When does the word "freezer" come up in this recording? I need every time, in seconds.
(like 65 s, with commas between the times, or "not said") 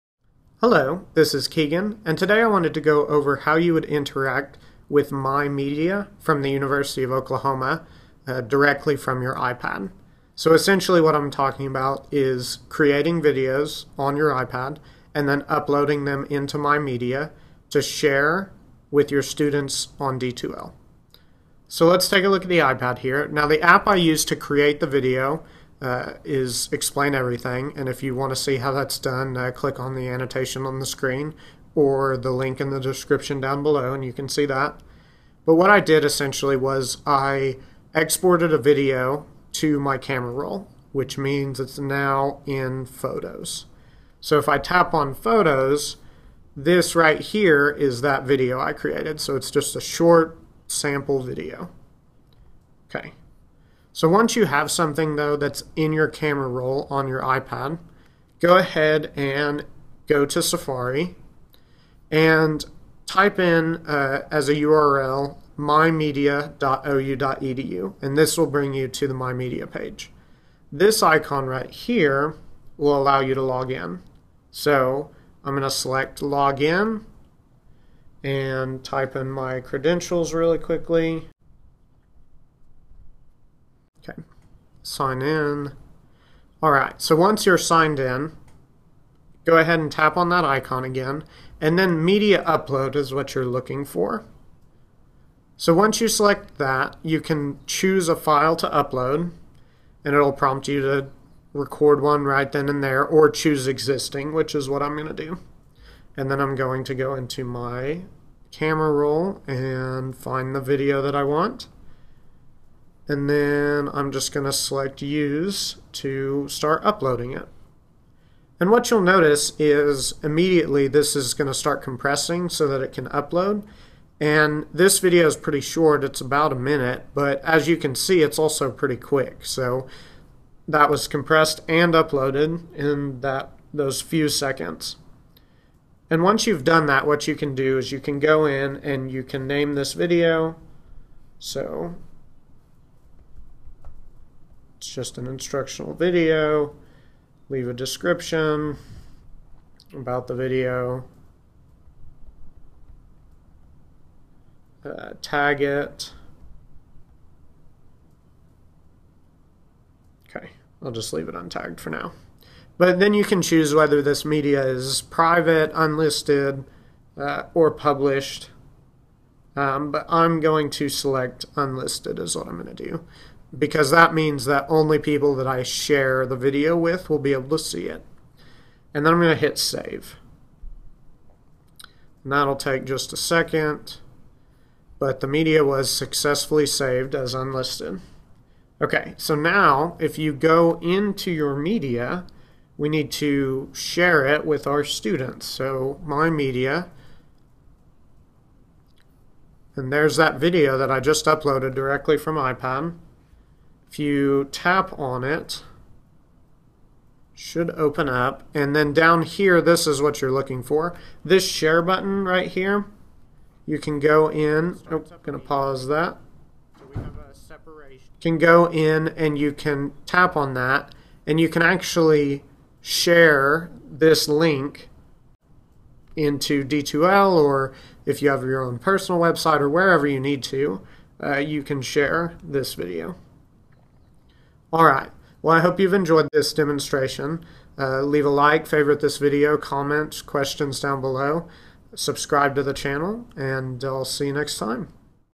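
not said.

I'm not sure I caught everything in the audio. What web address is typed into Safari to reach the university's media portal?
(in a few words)
mymedia.ou.edu.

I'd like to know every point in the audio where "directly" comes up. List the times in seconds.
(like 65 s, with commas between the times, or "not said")
8 s, 201 s.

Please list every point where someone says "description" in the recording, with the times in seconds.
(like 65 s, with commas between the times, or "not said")
32 s, 147 s.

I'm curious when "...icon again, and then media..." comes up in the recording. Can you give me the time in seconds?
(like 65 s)
90 s.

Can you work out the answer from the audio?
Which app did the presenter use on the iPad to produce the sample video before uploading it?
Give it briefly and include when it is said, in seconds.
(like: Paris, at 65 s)
Explain Everything, at 26 s.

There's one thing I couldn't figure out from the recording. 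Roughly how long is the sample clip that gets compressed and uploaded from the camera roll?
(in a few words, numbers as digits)
about a minute.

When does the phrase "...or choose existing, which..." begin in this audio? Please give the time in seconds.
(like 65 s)
103 s.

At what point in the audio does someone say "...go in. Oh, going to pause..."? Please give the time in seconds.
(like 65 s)
213 s.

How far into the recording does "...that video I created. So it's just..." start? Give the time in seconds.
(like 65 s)
48 s.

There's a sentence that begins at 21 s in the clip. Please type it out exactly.
So let's take a look at the iPad here.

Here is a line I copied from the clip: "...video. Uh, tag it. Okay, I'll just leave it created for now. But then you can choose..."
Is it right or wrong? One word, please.
wrong.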